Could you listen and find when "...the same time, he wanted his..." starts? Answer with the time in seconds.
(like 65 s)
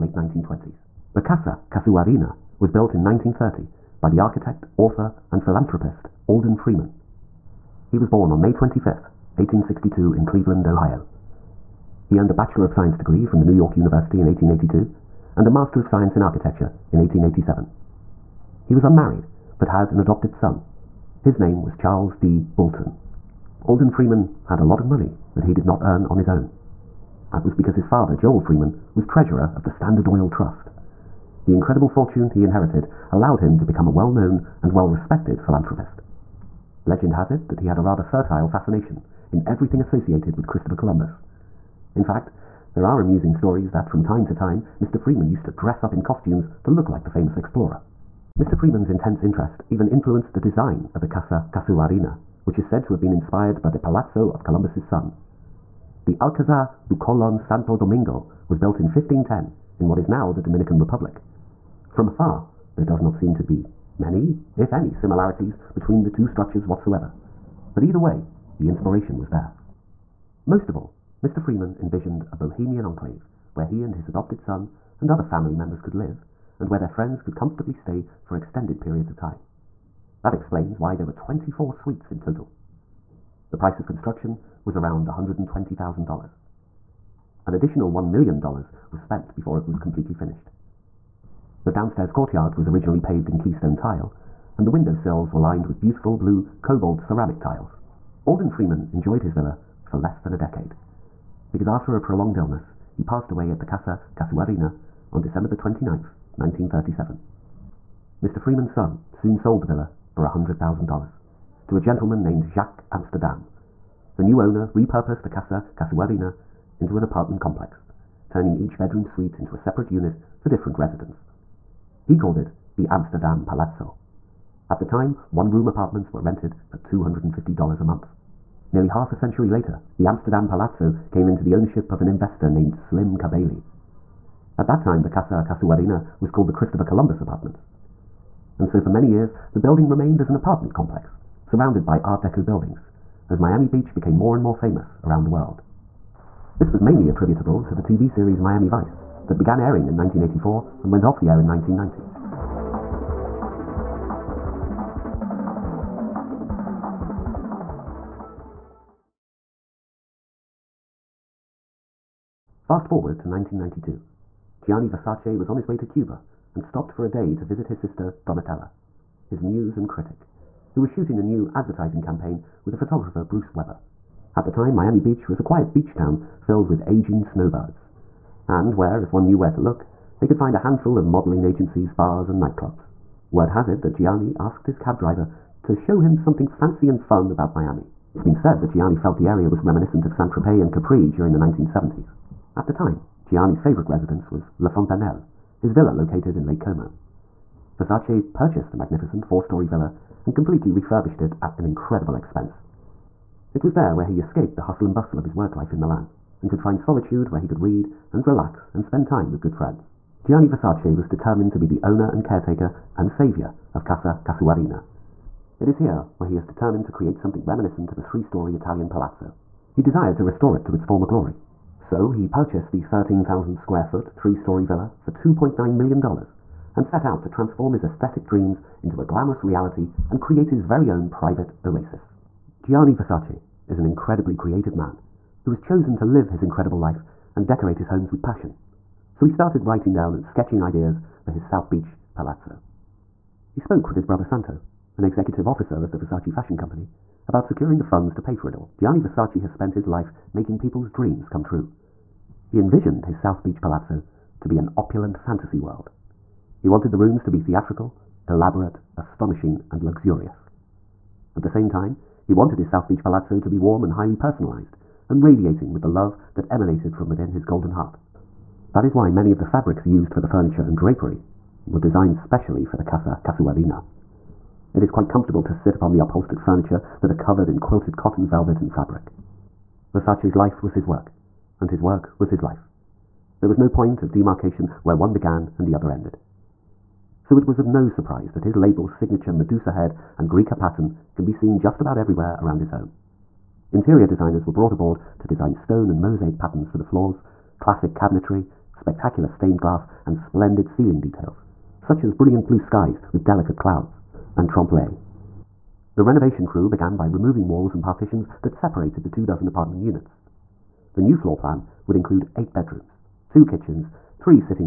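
261 s.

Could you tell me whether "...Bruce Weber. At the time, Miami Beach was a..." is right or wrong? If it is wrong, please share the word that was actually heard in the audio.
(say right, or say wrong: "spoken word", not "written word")
right.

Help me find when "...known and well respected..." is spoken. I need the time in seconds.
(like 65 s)
34 s.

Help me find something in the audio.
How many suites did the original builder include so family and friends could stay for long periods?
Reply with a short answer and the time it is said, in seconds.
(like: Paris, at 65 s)
24, at 81 s.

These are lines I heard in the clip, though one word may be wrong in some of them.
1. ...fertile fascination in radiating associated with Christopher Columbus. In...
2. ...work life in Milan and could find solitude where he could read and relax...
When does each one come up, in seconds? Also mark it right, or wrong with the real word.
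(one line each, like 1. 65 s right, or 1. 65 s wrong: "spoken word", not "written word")
1. 38 s wrong: "everything", not "radiating"
2. 205 s right.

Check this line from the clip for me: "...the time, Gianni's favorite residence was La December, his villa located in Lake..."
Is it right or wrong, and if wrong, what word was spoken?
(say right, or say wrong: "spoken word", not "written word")
wrong: "Fontanelle", not "December".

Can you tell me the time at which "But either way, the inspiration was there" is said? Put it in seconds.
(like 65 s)
67 s.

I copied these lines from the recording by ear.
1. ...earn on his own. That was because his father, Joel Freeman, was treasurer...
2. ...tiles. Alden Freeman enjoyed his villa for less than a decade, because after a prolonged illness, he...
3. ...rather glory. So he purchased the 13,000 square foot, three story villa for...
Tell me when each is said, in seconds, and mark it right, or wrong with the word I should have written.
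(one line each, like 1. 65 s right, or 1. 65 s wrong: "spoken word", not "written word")
1. 25 s right
2. 97 s right
3. 220 s wrong: "former", not "rather".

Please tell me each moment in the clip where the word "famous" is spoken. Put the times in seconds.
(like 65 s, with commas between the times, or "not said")
47 s, 144 s.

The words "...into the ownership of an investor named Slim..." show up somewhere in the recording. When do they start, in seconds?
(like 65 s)
131 s.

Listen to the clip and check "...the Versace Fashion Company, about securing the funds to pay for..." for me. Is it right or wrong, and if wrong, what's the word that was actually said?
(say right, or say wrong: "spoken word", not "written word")
right.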